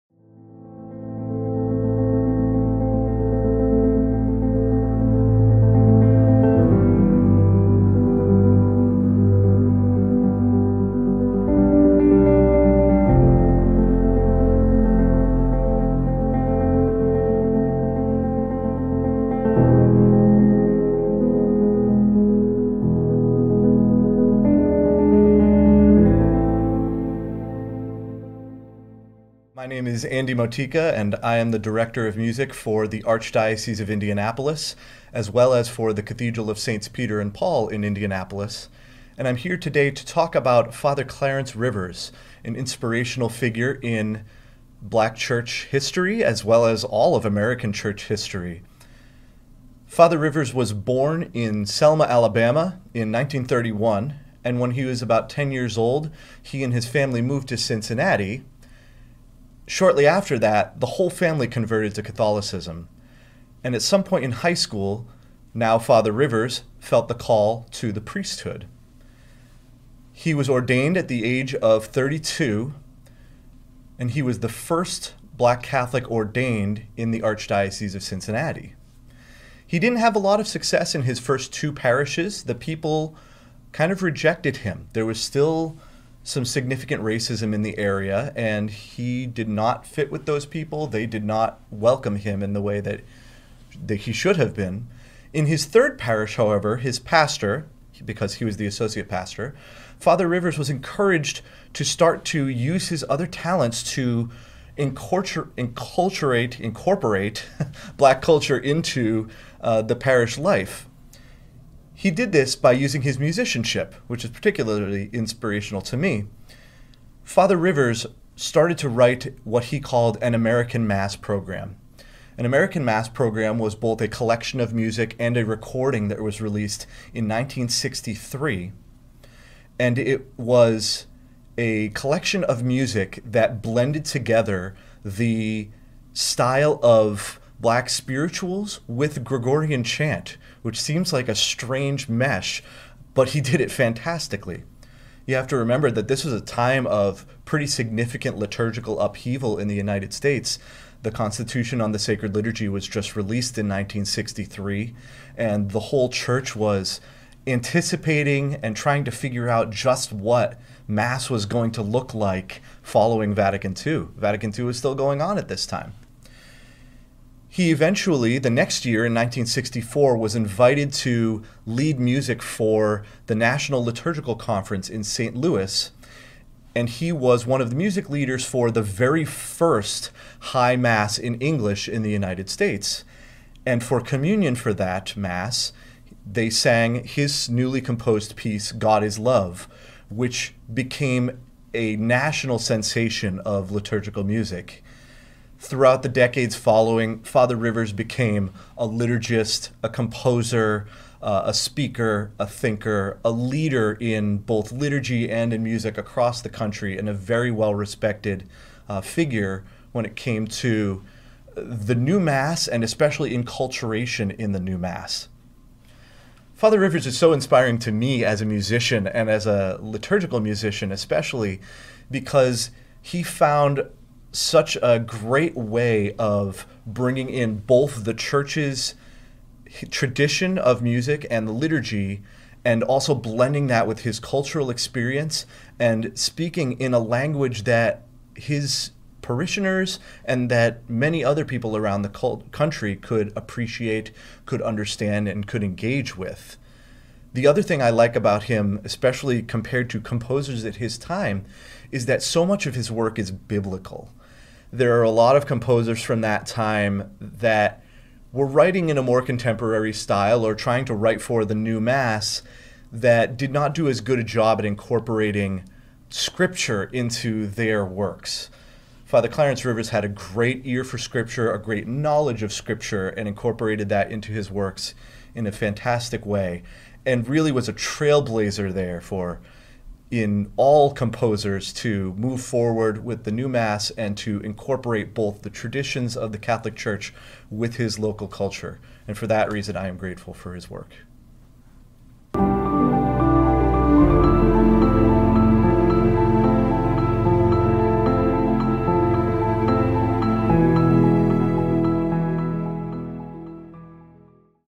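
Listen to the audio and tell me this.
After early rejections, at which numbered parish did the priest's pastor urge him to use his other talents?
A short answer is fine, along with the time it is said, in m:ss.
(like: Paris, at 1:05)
3rd, at 1:35.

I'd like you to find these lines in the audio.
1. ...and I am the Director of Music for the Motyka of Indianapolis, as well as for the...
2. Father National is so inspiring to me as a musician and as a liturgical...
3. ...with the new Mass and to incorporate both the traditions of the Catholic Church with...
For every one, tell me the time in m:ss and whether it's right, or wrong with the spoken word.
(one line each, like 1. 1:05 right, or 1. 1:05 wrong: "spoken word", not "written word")
1. 0:30 wrong: "Archdiocese", not "Motyka"
2. 3:36 wrong: "Rivers", not "National"
3. 4:43 right.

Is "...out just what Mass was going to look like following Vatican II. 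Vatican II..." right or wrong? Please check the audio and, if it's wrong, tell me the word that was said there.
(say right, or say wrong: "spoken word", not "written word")
right.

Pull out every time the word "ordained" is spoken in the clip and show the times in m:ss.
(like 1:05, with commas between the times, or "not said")
1:10, 1:16.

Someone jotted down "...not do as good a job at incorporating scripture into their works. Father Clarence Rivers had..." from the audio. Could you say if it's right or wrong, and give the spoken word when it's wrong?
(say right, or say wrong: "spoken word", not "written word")
right.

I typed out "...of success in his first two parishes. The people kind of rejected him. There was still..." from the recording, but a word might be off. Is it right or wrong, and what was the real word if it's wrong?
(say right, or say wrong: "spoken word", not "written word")
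right.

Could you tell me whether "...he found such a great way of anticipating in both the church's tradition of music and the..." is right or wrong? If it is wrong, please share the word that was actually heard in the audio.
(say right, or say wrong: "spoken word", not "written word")
wrong: "bringing", not "anticipating".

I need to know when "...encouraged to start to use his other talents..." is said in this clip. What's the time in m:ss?
1:40.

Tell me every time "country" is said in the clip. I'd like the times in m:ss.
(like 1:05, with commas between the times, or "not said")
3:26, 4:02.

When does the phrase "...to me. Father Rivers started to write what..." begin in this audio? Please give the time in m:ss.
1:55.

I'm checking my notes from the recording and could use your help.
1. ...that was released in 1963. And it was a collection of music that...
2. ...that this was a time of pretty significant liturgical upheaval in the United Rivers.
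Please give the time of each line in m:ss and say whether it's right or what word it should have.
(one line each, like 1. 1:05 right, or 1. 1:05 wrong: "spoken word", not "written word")
1. 2:06 right
2. 2:25 wrong: "States", not "Rivers".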